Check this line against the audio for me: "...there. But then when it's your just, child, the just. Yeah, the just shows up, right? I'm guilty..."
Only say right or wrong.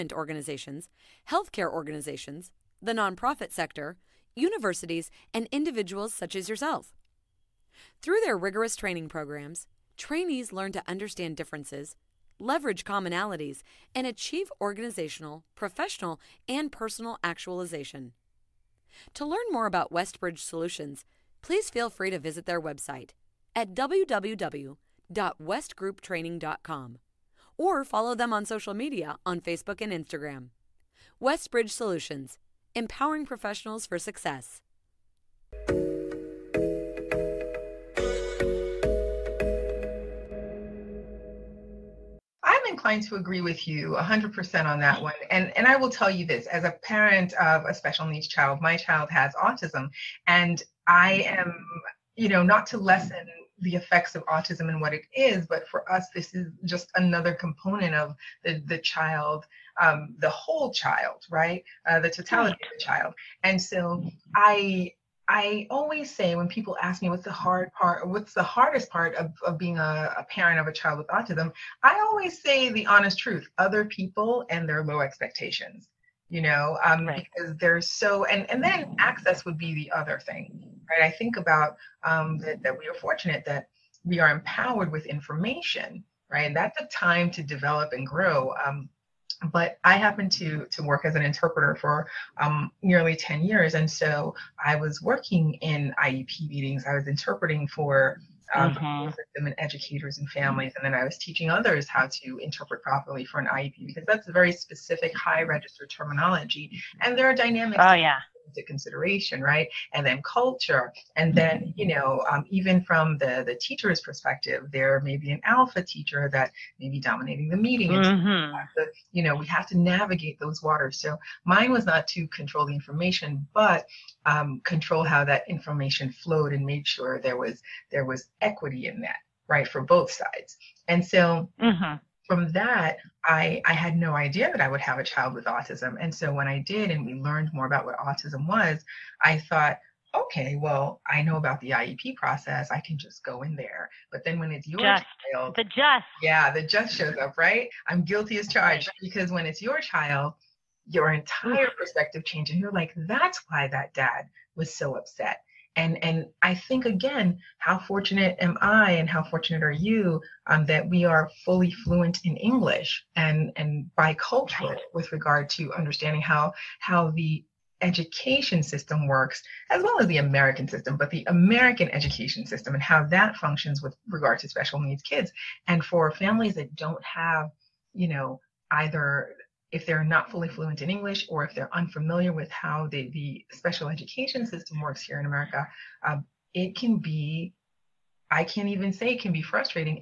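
right.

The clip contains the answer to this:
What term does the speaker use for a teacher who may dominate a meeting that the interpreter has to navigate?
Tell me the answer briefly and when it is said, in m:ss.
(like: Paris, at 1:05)
alpha teacher, at 1:55.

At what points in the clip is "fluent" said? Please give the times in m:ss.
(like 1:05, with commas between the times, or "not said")
2:41, 3:00.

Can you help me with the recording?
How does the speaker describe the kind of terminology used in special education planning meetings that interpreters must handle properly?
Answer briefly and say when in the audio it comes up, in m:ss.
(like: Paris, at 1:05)
high register terminology, at 1:45.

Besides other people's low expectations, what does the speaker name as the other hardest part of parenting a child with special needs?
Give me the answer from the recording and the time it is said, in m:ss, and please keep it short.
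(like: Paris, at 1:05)
access, at 1:18.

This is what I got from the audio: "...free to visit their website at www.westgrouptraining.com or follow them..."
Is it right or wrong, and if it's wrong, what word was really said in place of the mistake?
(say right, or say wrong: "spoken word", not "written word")
right.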